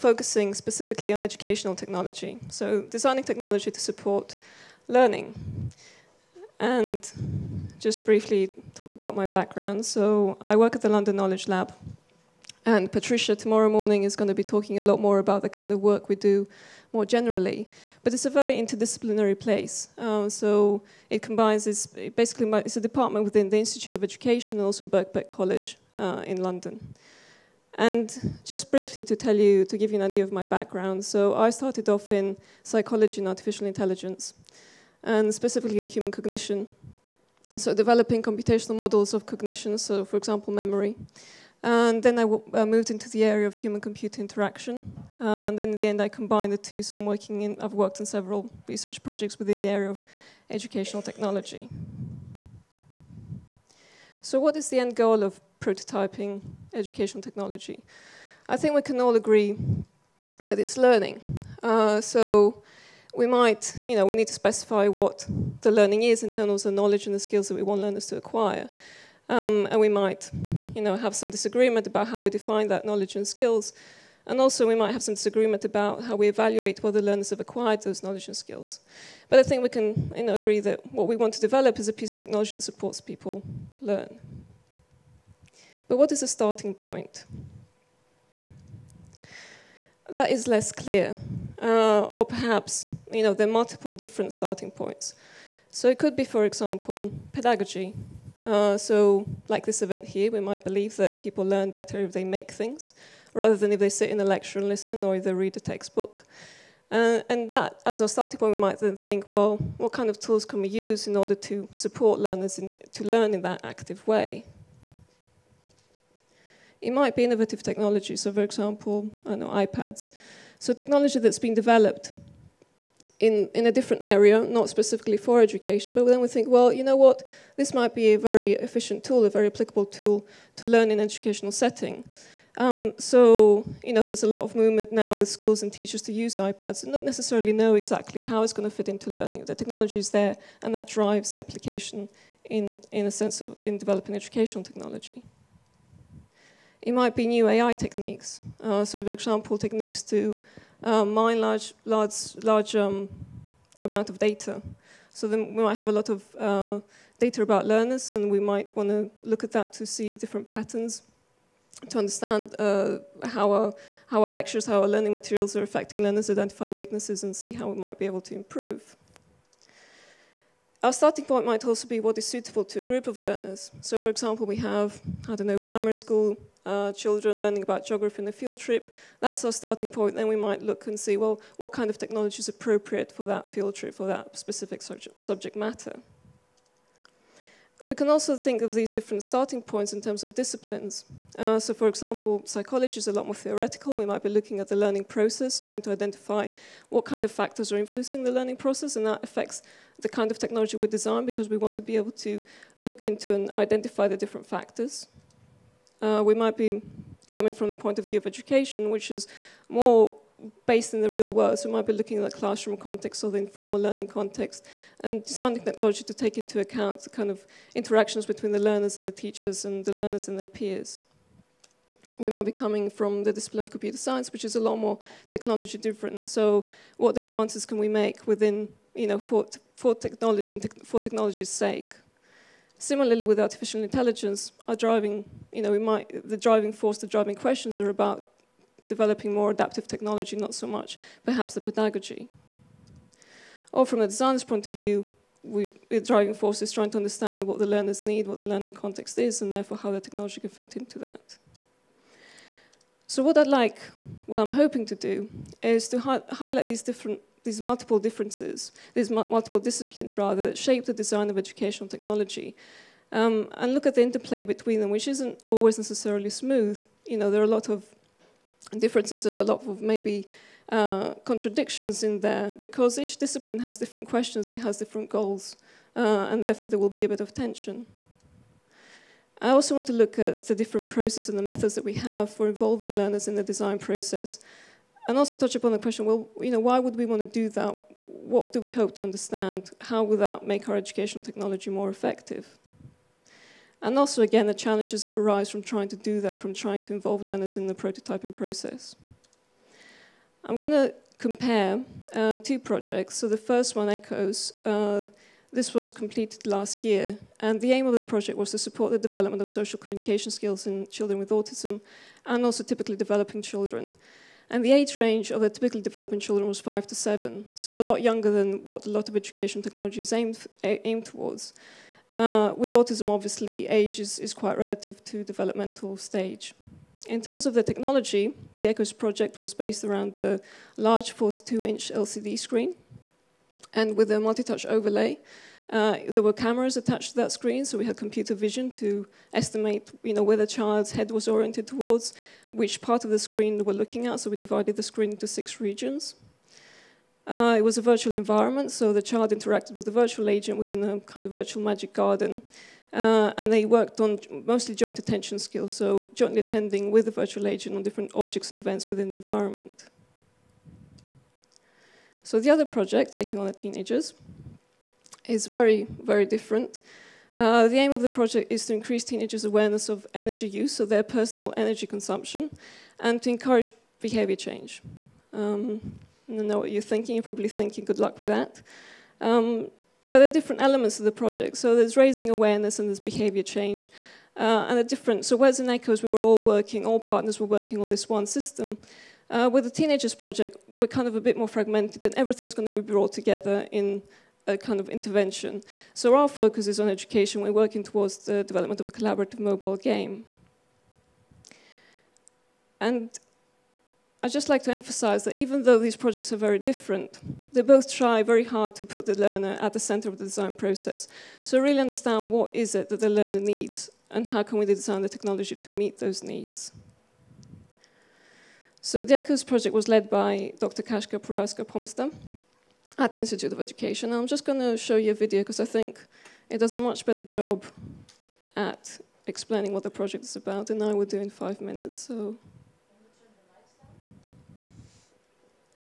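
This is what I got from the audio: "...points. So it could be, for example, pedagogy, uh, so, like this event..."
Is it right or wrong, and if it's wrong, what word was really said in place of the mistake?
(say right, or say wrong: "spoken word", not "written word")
right.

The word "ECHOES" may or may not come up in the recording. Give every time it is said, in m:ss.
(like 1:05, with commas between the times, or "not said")
5:03, 5:28, 6:25, 6:59.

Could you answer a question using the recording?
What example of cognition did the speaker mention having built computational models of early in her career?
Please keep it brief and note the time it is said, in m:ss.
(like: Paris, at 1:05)
memory, at 0:40.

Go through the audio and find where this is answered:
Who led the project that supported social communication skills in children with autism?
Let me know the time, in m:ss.
7:00.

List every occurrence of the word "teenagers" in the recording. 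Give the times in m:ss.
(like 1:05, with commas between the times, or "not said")
6:03, 6:09, 6:29.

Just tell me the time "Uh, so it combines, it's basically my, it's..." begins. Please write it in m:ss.
0:19.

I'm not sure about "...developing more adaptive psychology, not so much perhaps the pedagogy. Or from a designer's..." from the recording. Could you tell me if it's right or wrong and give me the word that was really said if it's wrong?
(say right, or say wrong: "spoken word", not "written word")
wrong: "technology", not "psychology".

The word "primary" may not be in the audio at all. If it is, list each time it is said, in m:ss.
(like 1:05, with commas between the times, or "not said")
2:55.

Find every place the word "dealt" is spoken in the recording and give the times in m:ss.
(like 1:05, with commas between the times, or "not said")
not said.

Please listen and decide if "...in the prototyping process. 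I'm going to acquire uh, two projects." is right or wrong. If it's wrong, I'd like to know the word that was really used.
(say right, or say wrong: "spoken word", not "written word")
wrong: "compare", not "acquire".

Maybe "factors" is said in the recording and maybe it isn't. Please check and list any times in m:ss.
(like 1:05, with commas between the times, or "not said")
3:17, 3:24.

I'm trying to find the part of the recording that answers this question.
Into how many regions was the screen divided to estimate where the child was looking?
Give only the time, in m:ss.
5:45.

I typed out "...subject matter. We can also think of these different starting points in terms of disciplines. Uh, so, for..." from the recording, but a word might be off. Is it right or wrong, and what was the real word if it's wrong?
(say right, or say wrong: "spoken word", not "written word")
right.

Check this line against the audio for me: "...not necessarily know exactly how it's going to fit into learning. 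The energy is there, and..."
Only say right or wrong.
wrong.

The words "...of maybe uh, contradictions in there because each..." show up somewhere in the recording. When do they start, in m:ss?
4:29.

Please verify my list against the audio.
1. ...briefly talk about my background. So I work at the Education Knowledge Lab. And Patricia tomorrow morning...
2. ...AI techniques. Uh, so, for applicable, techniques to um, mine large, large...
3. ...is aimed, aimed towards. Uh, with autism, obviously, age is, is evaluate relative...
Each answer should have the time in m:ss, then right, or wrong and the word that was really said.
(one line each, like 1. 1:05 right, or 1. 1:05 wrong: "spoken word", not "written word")
1. 0:08 wrong: "London", not "Education"
2. 2:27 wrong: "example", not "applicable"
3. 5:20 wrong: "quite", not "evaluate".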